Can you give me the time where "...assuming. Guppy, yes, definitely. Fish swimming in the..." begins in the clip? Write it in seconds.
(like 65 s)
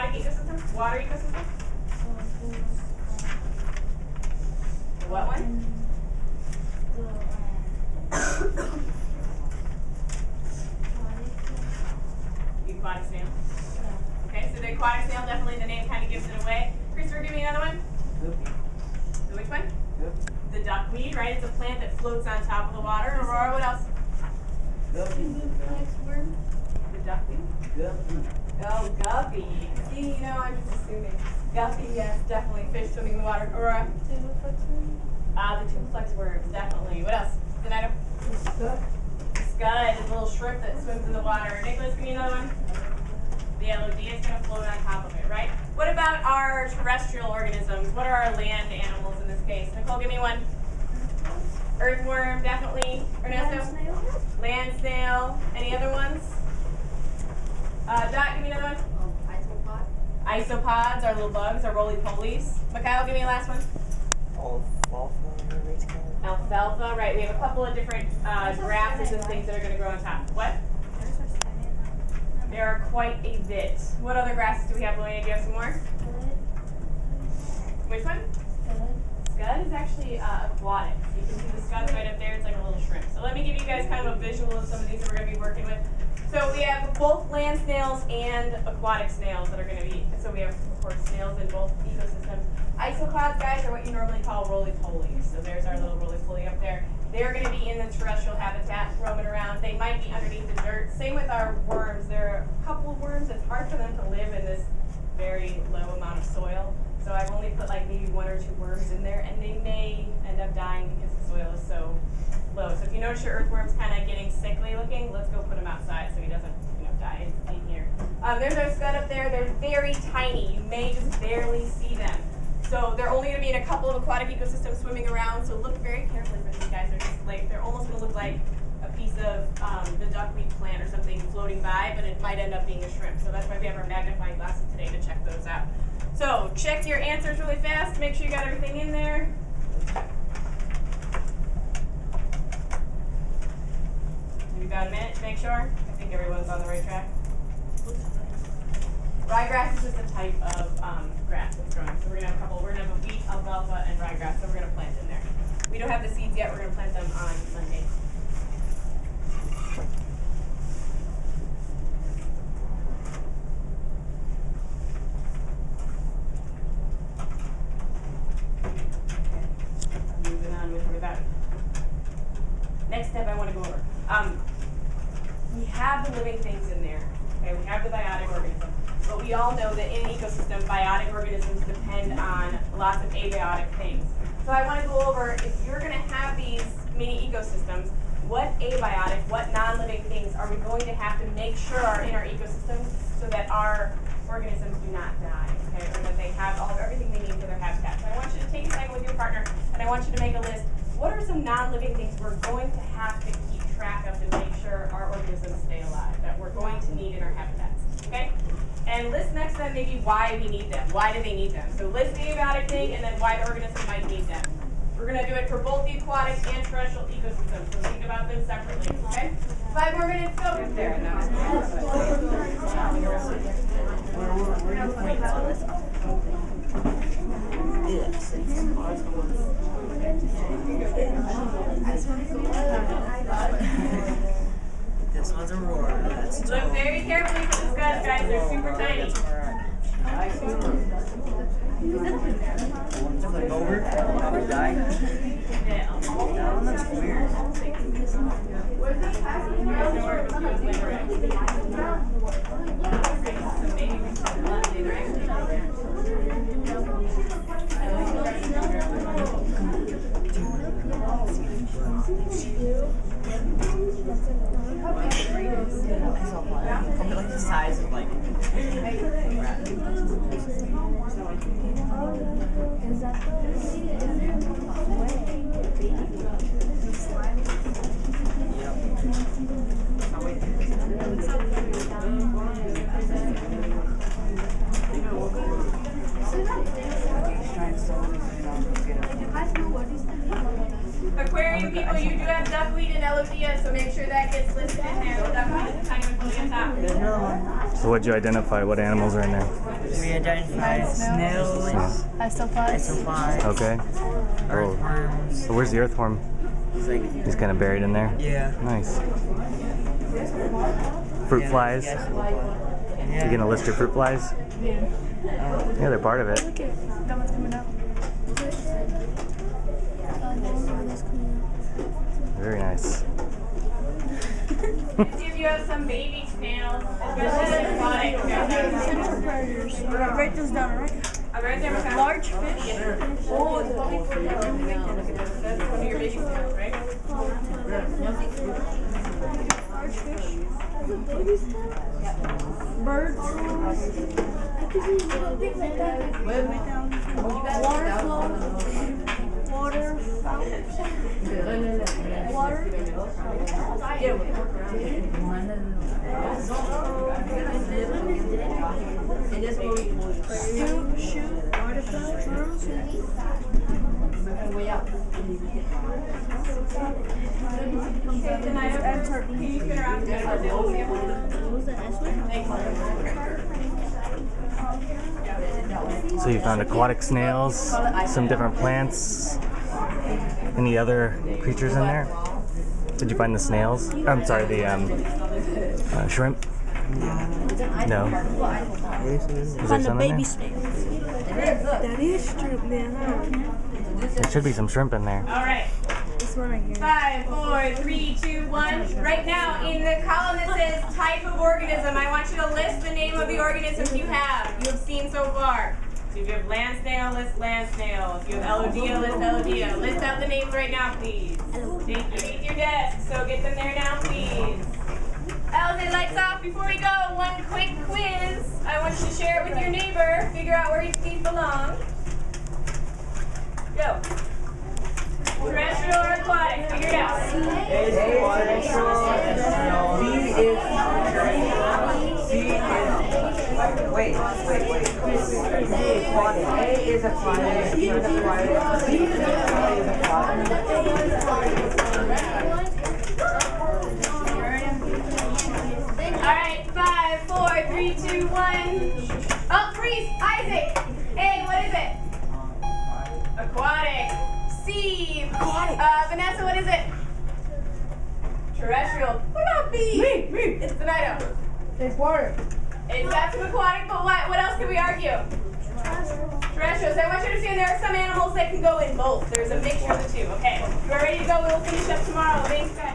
30 s.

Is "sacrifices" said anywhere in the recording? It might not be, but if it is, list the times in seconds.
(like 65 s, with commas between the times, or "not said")
not said.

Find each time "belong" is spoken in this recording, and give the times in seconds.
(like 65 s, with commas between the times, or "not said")
421 s.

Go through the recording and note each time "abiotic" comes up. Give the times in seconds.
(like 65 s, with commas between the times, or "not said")
183 s, 188 s, 212 s.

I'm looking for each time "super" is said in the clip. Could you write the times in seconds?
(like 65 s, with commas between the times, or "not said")
238 s.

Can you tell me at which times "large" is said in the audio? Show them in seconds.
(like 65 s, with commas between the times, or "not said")
331 s, 339 s.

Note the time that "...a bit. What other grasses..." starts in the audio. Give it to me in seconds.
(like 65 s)
73 s.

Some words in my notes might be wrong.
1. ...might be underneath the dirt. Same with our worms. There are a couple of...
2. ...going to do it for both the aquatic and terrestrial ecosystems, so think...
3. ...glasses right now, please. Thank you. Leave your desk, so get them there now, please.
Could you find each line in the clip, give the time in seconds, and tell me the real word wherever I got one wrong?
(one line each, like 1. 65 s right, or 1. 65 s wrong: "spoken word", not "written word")
1. 99 s right
2. 215 s right
3. 410 s wrong: "names", not "glasses".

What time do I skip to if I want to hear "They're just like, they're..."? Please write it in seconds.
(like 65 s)
126 s.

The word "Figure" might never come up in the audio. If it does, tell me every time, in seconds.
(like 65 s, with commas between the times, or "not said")
420 s, 426 s.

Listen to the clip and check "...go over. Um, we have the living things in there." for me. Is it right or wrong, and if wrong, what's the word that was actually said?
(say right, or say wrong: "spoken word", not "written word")
right.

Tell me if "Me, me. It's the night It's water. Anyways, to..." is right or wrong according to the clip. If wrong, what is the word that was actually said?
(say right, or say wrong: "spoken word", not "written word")
right.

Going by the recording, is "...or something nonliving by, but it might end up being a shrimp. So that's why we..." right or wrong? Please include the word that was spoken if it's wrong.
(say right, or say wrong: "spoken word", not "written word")
wrong: "floating", not "nonliving".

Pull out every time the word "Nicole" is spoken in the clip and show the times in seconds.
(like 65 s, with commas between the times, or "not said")
49 s.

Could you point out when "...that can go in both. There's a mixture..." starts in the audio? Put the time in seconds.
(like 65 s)
468 s.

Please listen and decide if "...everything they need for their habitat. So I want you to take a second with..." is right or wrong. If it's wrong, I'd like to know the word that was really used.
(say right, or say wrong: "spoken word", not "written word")
right.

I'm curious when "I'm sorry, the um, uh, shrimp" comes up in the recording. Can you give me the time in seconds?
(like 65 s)
384 s.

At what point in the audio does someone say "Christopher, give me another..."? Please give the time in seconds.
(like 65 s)
16 s.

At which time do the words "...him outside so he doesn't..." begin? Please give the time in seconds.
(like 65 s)
115 s.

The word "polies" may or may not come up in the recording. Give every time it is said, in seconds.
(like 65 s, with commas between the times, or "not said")
61 s, 94 s.